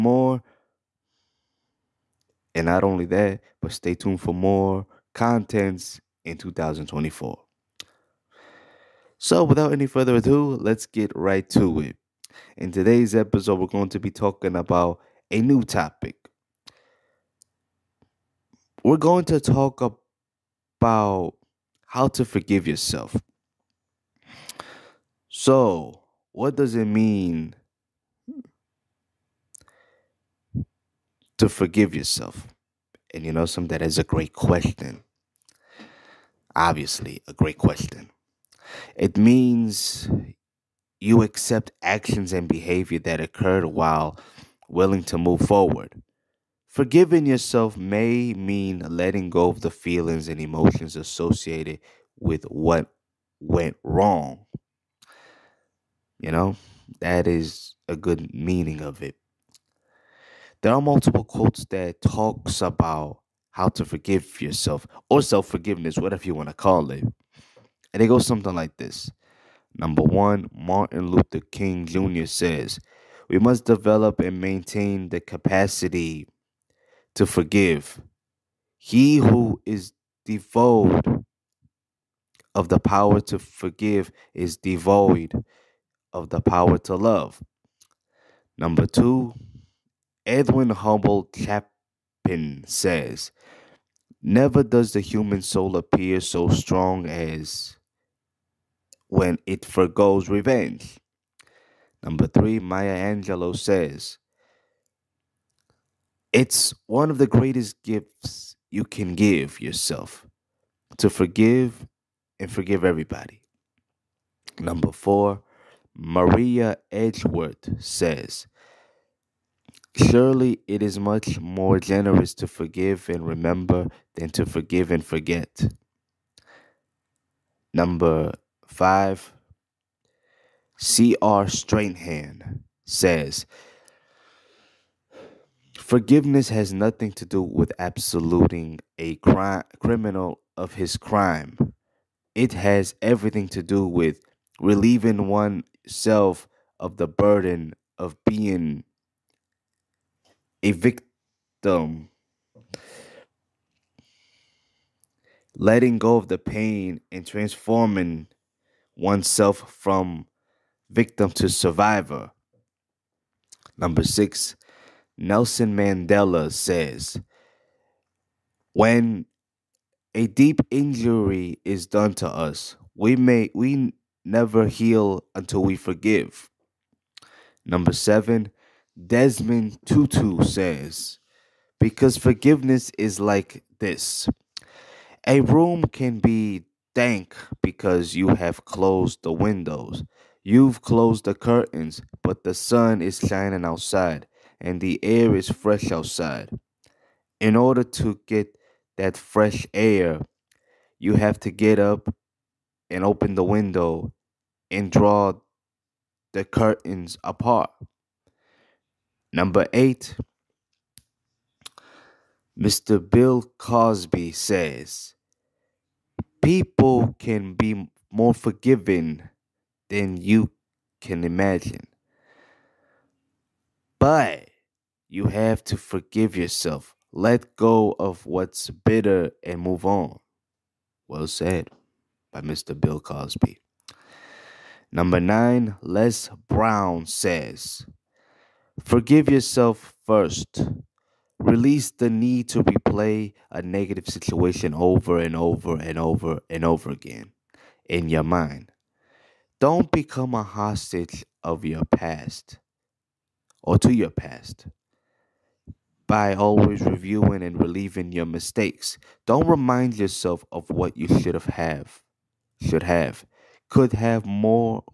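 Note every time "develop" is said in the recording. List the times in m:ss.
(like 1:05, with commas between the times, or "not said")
1:13.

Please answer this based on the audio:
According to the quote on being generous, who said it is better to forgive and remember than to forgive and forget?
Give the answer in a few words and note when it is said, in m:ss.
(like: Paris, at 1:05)
Maria Edgeworth, at 1:55.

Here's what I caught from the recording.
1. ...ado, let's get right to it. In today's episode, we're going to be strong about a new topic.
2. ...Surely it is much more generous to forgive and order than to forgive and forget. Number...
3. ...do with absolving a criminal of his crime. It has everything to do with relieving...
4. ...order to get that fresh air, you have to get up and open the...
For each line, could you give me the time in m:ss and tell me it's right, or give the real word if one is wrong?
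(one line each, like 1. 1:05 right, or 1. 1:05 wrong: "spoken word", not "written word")
1. 0:10 wrong: "talking", not "strong"
2. 1:59 wrong: "remember", not "order"
3. 2:17 right
4. 3:17 right.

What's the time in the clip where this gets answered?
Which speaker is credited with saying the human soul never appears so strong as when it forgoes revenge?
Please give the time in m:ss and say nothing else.
1:30.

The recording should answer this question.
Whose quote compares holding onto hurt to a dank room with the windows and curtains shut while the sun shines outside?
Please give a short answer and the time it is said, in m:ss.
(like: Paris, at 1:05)
Desmond Tutu, at 2:58.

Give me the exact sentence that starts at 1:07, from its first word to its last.
And it goes something like this.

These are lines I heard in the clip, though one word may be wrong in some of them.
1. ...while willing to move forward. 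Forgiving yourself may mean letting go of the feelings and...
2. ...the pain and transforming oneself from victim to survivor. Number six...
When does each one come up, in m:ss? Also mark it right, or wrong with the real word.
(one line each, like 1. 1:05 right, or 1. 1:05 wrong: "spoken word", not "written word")
1. 0:43 right
2. 2:36 right.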